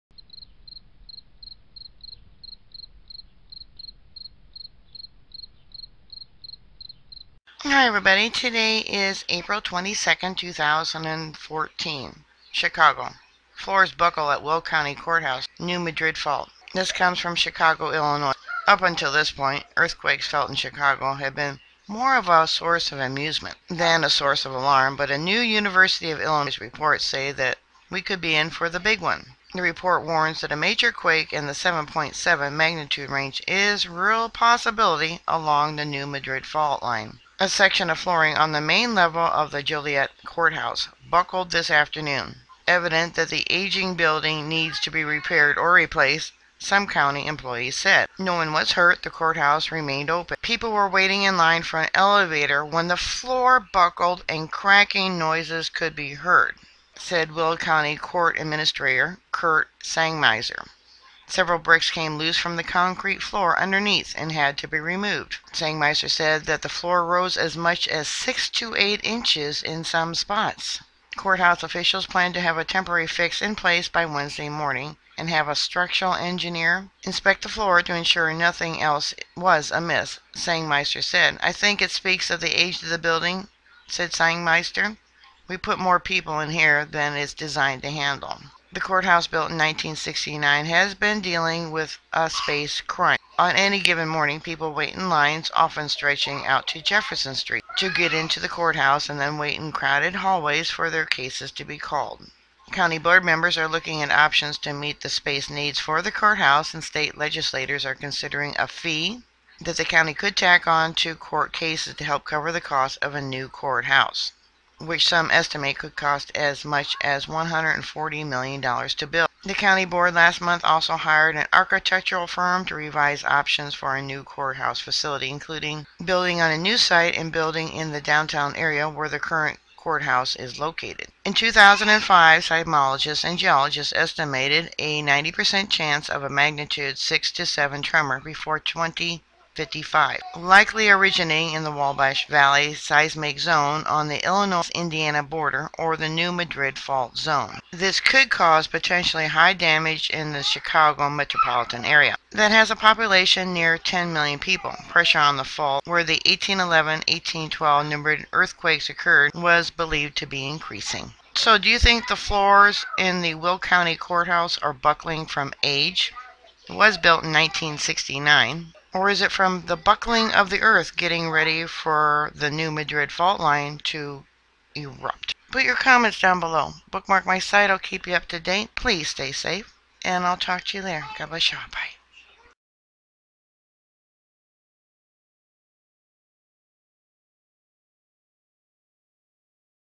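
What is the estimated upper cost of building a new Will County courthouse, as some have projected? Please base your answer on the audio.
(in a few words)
$140 million.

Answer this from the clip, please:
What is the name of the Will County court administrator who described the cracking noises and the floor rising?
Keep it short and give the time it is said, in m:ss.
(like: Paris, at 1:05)
Kurt Sangmeister, at 0:59.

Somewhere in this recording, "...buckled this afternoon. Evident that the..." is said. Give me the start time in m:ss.
0:41.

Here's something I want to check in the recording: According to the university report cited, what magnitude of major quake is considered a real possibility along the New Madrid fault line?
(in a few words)
7.7.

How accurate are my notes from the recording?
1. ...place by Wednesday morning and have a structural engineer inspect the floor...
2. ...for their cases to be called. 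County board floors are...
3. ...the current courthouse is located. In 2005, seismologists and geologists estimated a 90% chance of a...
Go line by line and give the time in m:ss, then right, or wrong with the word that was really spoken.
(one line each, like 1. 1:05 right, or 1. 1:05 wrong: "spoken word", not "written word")
1. 1:13 right
2. 1:40 wrong: "members", not "floors"
3. 2:09 right.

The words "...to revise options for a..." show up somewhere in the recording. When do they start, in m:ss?
2:02.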